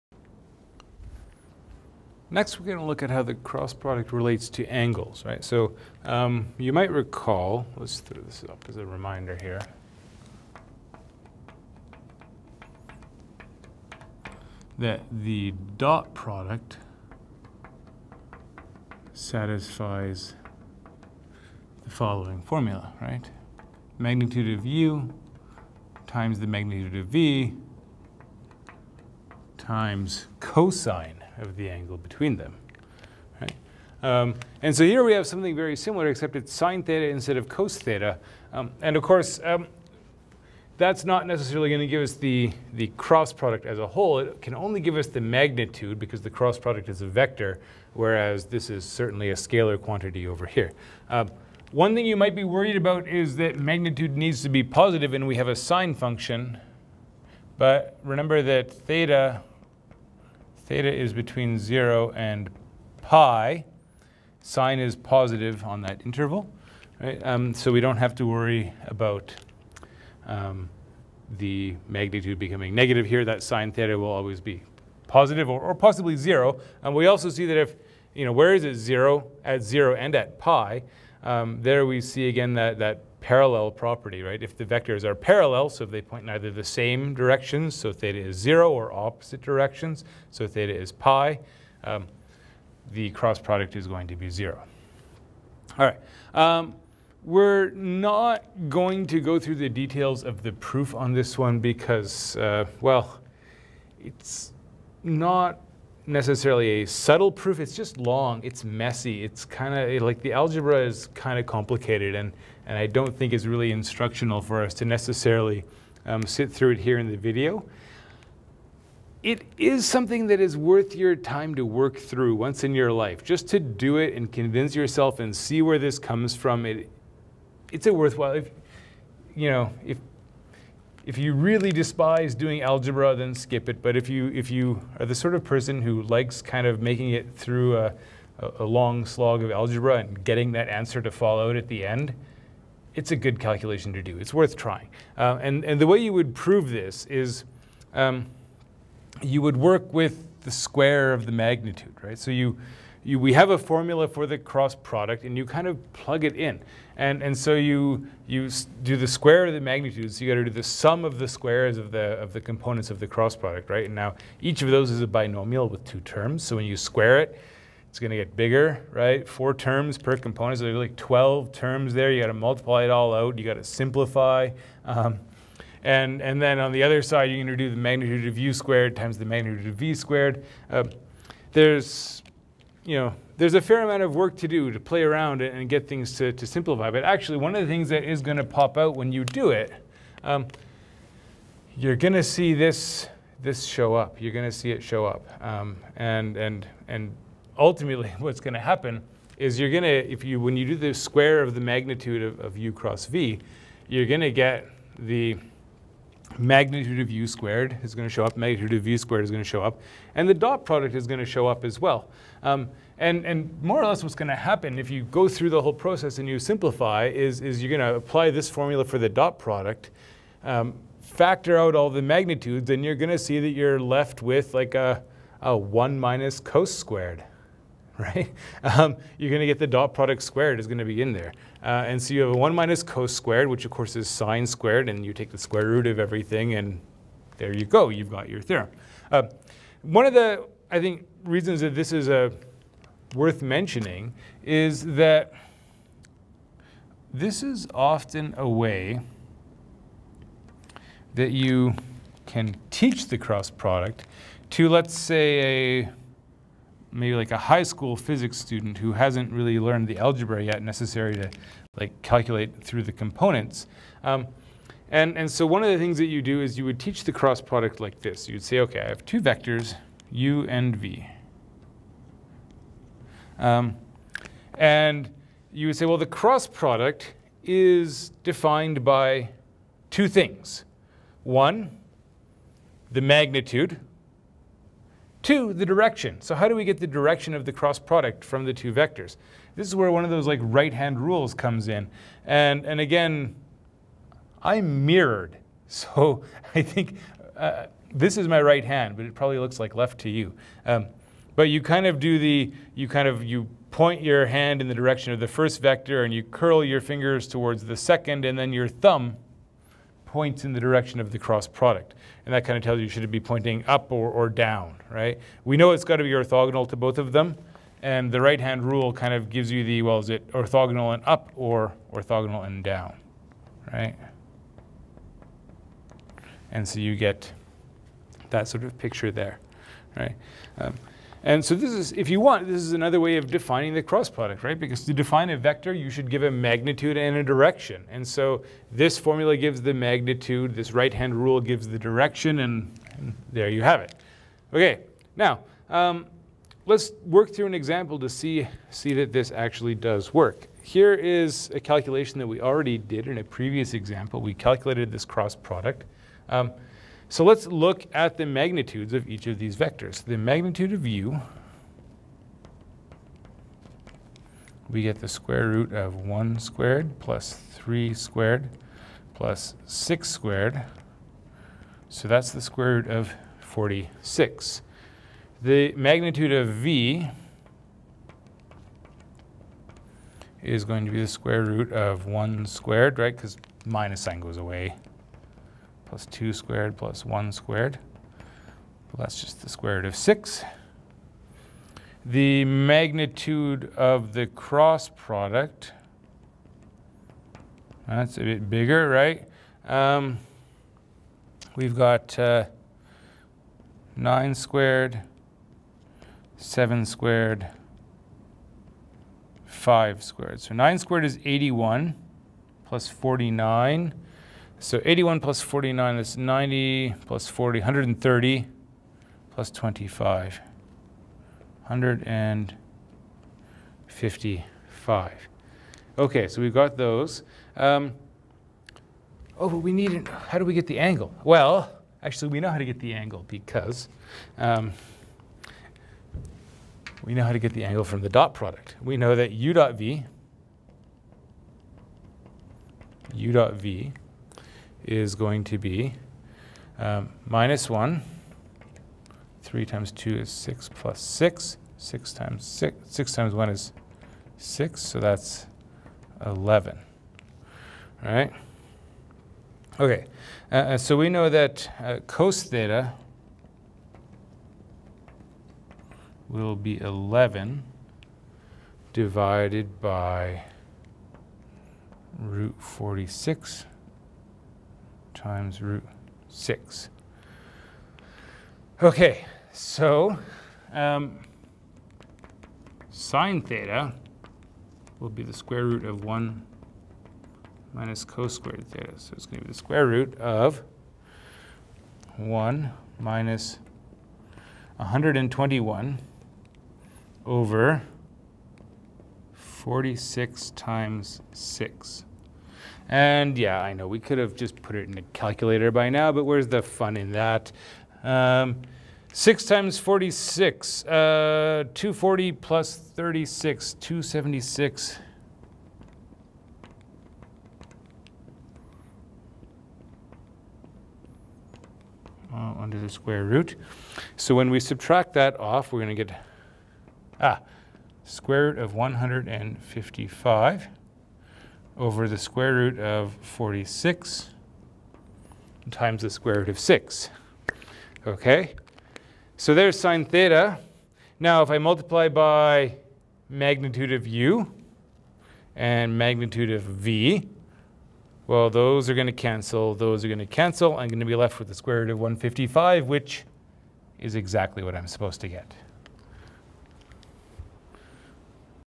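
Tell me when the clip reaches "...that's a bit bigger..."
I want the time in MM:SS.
06:37.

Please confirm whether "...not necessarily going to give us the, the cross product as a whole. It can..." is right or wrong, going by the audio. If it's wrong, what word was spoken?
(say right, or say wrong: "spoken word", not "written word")
right.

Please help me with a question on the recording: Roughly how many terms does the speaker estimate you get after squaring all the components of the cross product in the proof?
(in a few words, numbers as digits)
12.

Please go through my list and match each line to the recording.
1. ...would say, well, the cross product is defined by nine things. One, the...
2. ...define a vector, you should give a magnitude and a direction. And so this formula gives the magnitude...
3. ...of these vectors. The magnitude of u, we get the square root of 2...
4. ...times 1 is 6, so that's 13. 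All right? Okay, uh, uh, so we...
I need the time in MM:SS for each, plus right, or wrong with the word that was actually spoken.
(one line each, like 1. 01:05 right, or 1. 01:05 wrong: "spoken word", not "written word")
1. 04:35 wrong: "two", not "nine"
2. 05:34 right
3. 05:59 wrong: "1", not "2"
4. 07:33 wrong: "11", not "13".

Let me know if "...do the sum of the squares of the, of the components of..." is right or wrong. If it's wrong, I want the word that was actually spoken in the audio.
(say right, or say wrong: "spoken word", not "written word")
right.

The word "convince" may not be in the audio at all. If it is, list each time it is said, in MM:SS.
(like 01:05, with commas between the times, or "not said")
02:04.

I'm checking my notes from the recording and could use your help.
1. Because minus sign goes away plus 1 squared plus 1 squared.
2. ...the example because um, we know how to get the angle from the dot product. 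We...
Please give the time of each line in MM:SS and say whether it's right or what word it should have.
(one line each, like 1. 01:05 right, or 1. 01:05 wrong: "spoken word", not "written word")
1. 06:23 wrong: "2", not "1"
2. 07:12 wrong: "angle", not "example".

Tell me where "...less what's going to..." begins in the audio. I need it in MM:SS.
03:33.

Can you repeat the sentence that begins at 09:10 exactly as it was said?
I'm going to be left with the square root of 155, which is exactly what I'm supposed to get.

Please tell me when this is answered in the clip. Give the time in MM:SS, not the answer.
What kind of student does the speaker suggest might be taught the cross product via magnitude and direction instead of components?
04:17.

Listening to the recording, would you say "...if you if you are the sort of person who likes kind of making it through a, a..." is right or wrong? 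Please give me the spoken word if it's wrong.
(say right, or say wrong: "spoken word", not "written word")
right.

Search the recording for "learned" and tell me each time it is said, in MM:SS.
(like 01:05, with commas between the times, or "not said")
04:19.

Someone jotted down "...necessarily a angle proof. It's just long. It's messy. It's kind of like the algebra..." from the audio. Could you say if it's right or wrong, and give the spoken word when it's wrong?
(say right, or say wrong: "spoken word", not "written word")
wrong: "subtle", not "angle".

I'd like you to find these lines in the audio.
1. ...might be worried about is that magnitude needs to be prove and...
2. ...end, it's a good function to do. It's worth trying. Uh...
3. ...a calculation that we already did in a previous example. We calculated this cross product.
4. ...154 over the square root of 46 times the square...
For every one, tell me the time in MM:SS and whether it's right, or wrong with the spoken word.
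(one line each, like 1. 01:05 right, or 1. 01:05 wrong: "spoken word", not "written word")
1. 00:52 wrong: "positive", not "prove"
2. 02:21 wrong: "calculation", not "function"
3. 05:51 right
4. 08:48 wrong: "155", not "154".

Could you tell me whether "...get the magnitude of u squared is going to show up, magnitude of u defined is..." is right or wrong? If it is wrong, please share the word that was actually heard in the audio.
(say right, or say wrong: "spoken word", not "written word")
wrong: "squared", not "defined".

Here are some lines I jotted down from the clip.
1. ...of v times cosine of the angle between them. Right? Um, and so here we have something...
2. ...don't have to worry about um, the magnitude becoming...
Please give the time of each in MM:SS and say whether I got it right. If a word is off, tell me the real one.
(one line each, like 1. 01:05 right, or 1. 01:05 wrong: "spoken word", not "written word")
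1. 00:26 right
2. 01:07 right.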